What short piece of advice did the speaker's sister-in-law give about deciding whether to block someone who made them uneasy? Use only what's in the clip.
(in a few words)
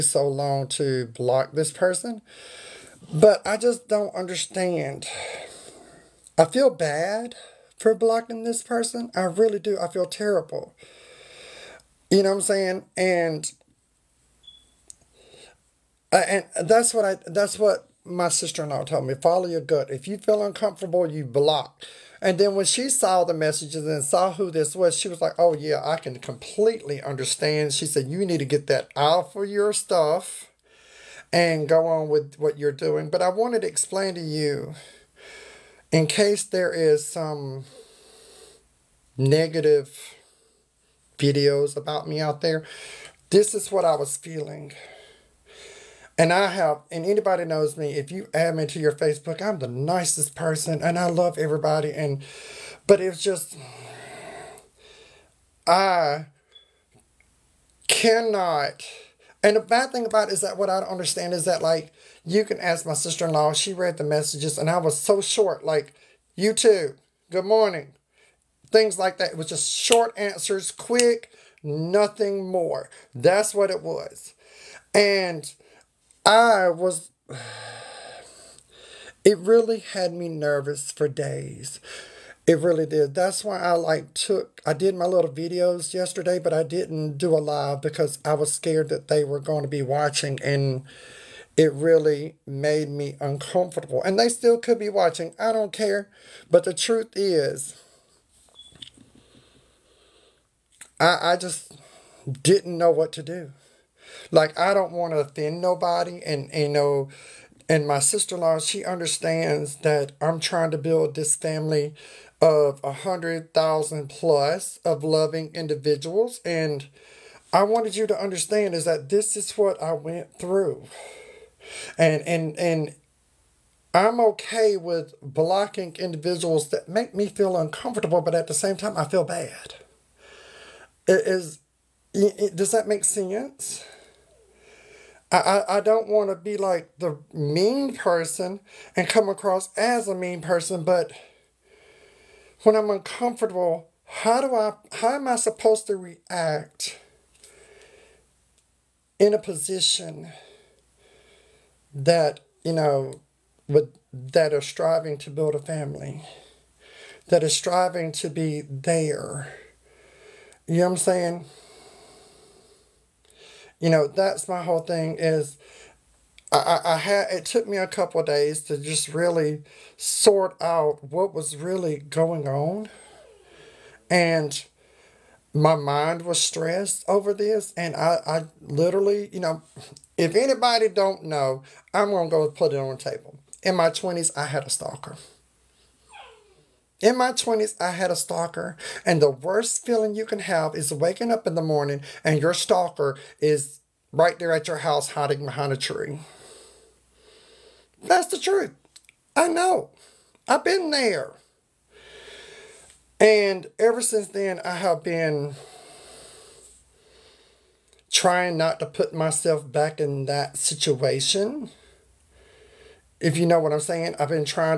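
Follow your gut.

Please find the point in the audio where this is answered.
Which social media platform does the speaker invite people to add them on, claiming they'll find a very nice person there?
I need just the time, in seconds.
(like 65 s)
48 s.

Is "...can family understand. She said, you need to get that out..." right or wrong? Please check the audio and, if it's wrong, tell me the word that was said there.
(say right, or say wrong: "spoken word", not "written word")
wrong: "completely", not "family".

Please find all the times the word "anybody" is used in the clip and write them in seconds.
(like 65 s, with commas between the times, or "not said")
47 s, 180 s.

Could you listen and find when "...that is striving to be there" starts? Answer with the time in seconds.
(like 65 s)
157 s.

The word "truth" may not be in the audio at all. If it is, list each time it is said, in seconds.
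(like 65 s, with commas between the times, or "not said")
96 s, 198 s.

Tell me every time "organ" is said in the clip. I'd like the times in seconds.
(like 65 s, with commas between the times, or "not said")
not said.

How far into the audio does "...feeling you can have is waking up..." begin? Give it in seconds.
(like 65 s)
189 s.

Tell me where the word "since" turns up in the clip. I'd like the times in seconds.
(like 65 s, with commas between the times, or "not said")
204 s.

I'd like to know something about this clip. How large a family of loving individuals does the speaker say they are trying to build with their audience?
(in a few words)
100,000 plus.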